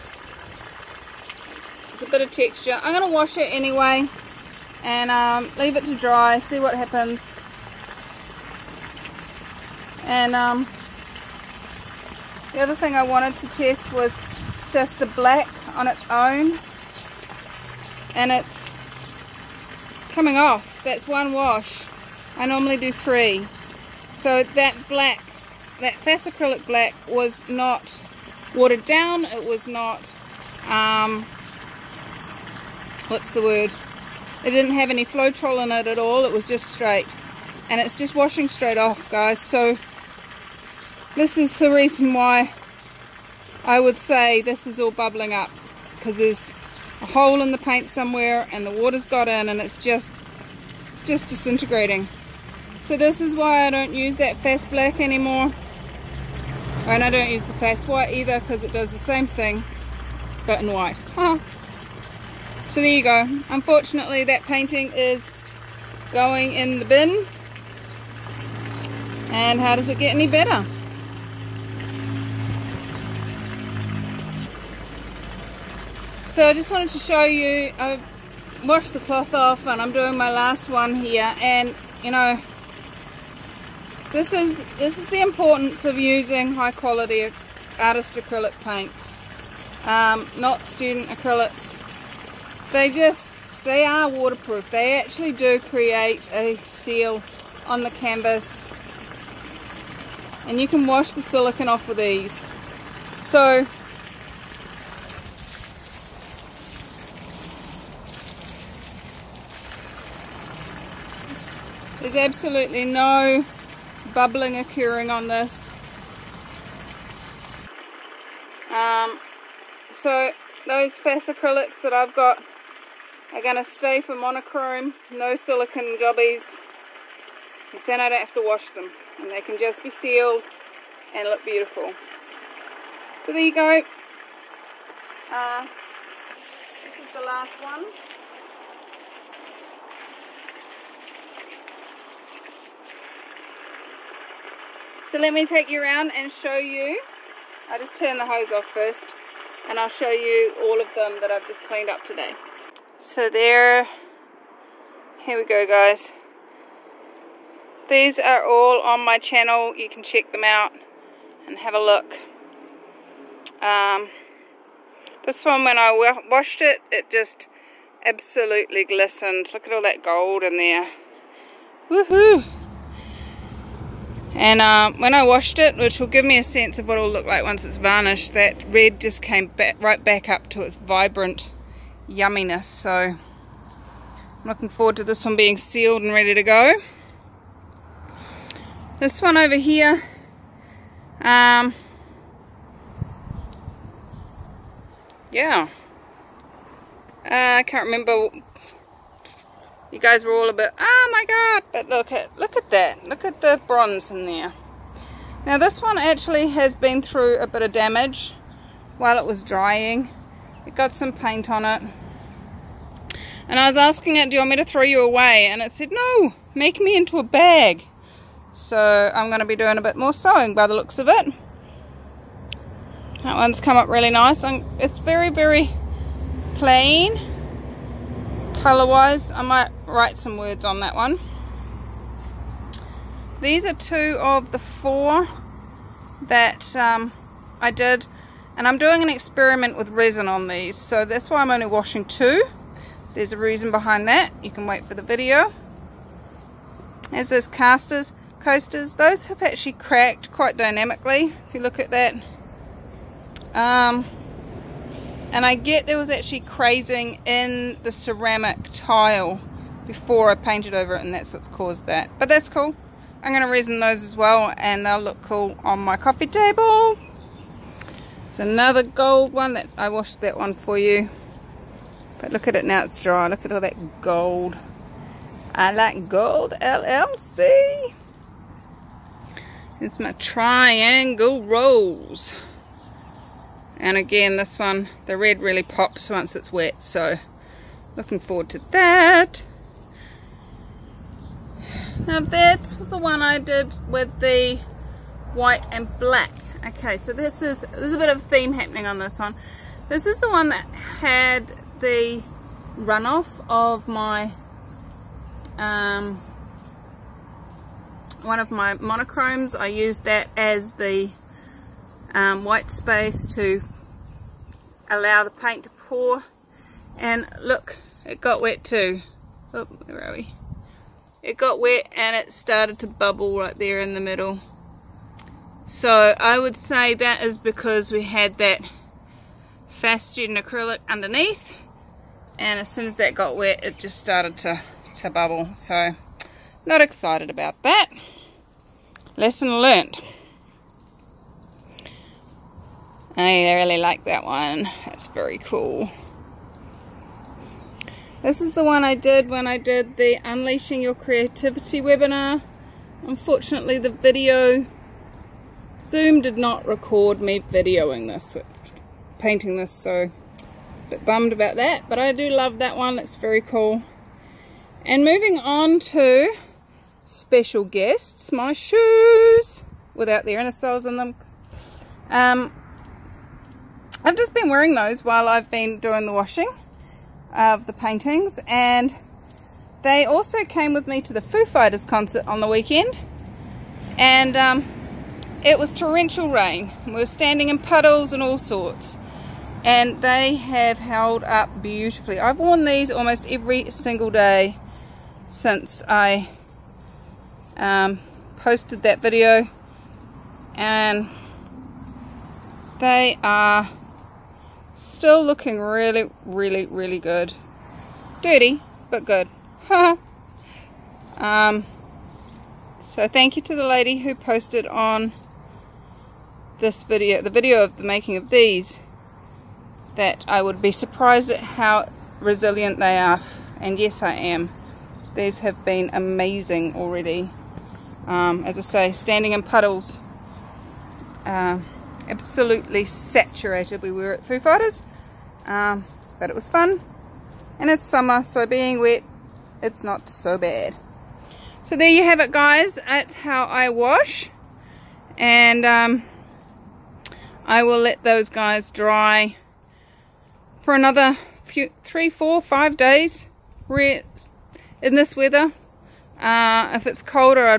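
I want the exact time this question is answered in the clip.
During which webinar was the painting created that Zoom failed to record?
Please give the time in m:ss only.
5:50.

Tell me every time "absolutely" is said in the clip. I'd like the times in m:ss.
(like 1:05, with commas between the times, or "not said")
1:52, 2:48, 7:12.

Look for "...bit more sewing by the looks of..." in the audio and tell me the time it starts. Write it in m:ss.
3:39.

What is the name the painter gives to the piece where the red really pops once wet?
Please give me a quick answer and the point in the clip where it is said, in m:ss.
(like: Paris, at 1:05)
Triangle rose, at 4:40.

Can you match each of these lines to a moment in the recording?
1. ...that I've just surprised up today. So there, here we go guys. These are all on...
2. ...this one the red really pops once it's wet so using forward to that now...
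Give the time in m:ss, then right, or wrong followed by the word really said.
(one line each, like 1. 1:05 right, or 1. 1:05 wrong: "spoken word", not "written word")
1. 2:31 wrong: "cleaned", not "surprised"
2. 4:44 wrong: "looking", not "using".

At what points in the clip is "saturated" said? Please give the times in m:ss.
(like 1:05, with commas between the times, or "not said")
7:12.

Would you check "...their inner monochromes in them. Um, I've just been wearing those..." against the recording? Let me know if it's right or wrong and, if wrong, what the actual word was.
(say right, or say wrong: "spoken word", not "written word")
wrong: "soles", not "monochromes".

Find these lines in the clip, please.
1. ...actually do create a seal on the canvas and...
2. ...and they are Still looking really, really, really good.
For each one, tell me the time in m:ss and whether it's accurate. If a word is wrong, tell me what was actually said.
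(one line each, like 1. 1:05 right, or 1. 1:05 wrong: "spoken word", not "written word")
1. 1:34 right
2. 6:40 right.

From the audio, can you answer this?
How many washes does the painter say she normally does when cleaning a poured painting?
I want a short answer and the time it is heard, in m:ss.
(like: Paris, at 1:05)
3, at 0:22.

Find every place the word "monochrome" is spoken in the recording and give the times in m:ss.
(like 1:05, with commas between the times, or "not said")
2:04, 5:08.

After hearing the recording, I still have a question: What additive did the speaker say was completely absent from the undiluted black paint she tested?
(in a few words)
Floetrol.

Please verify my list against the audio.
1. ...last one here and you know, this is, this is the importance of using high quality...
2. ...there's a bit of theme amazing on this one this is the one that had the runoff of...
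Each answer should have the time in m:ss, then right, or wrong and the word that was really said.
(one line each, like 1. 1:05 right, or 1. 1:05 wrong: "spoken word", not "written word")
1. 1:20 right
2. 4:57 wrong: "happening", not "amazing".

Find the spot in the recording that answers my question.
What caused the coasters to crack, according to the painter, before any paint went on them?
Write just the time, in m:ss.
4:16.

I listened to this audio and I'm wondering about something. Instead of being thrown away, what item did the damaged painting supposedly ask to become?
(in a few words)
A bag.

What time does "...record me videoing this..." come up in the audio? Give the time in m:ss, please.
5:56.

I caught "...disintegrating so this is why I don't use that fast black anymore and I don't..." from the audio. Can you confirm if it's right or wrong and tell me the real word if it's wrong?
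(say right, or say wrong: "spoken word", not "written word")
right.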